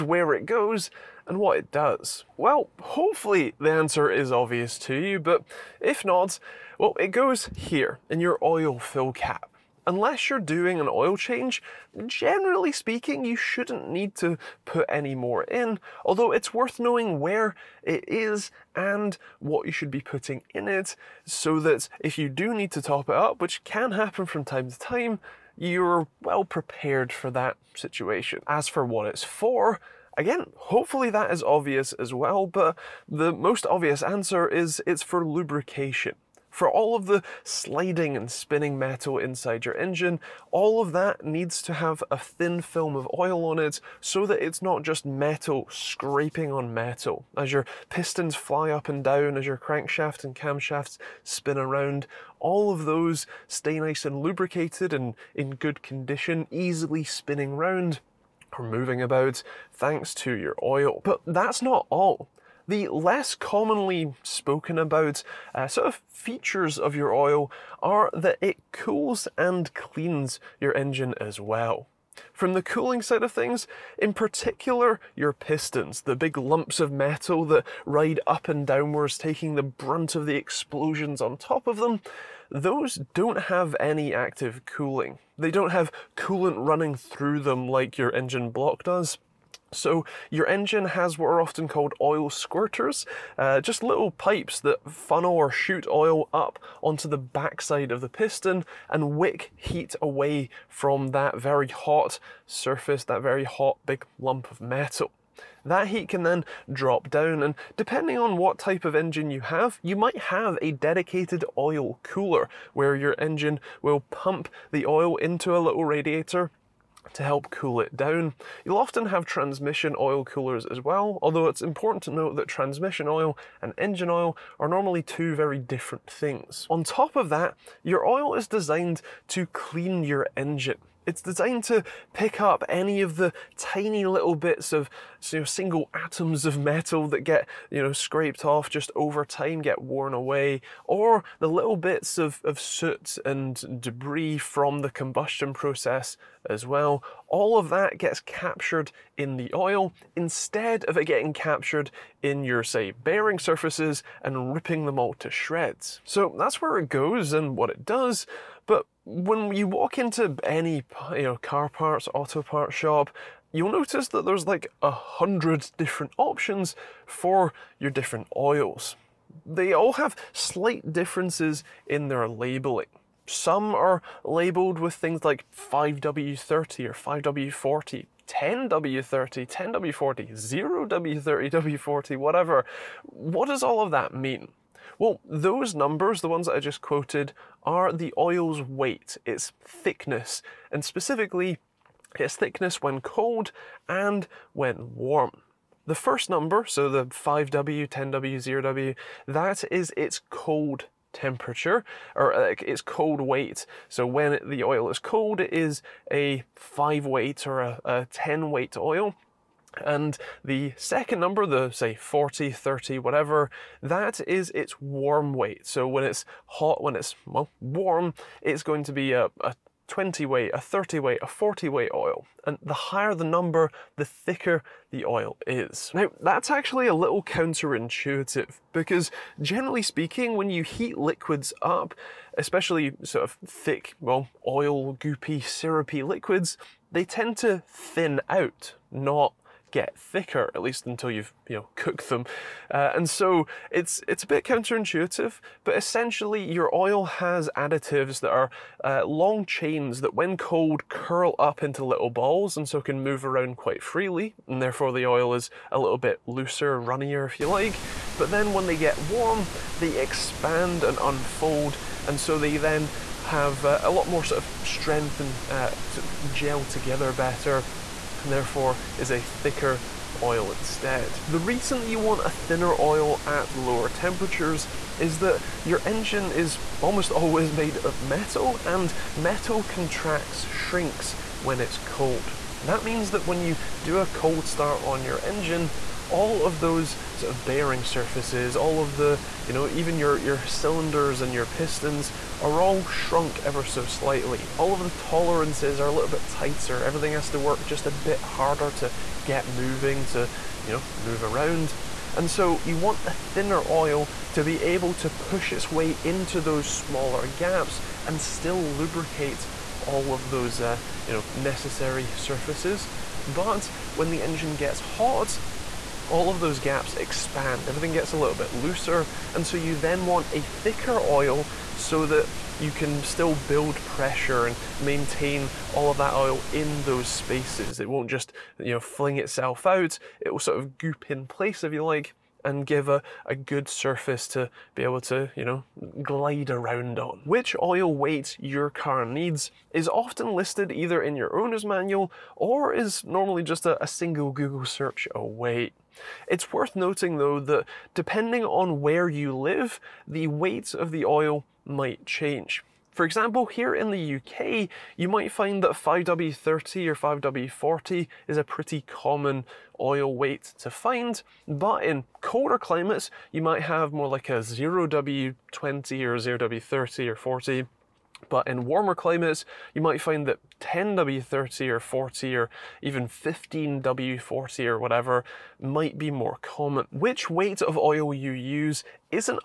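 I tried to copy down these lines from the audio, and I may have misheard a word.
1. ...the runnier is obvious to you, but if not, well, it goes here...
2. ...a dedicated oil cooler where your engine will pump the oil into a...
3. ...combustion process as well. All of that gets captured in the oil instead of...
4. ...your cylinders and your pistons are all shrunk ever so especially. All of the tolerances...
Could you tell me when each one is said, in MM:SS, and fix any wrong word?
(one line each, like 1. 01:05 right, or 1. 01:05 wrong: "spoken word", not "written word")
1. 00:03 wrong: "answer", not "runnier"
2. 01:50 right
3. 02:24 right
4. 04:50 wrong: "slightly", not "especially".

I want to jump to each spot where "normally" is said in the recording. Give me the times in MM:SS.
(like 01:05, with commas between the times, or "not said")
02:04, 05:43.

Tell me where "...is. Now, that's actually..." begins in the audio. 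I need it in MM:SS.
03:45.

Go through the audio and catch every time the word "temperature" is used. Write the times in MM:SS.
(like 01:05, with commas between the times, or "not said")
03:21, 04:33.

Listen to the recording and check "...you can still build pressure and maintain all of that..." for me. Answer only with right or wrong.
right.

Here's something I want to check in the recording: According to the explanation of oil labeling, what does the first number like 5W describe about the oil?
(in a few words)
its cold weight.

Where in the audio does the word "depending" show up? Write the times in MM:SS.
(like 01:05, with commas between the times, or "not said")
01:47, 05:47.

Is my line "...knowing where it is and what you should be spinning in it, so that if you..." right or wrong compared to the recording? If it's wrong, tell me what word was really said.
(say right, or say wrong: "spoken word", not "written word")
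wrong: "putting", not "spinning".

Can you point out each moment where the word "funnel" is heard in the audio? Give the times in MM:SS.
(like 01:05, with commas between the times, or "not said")
01:34.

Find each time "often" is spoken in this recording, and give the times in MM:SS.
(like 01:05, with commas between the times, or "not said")
01:31, 01:58, 05:39.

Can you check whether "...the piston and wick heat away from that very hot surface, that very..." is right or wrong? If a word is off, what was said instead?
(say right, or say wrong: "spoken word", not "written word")
right.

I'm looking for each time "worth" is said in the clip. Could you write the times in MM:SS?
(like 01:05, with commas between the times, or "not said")
00:16, 05:46.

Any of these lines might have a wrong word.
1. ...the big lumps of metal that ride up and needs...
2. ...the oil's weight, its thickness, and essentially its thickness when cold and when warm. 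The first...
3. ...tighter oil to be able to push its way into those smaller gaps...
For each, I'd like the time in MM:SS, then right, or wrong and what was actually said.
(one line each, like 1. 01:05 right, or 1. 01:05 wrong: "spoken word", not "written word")
1. 01:16 wrong: "downwards", not "needs"
2. 03:07 wrong: "specifically", not "essentially"
3. 05:03 wrong: "thinner", not "tighter".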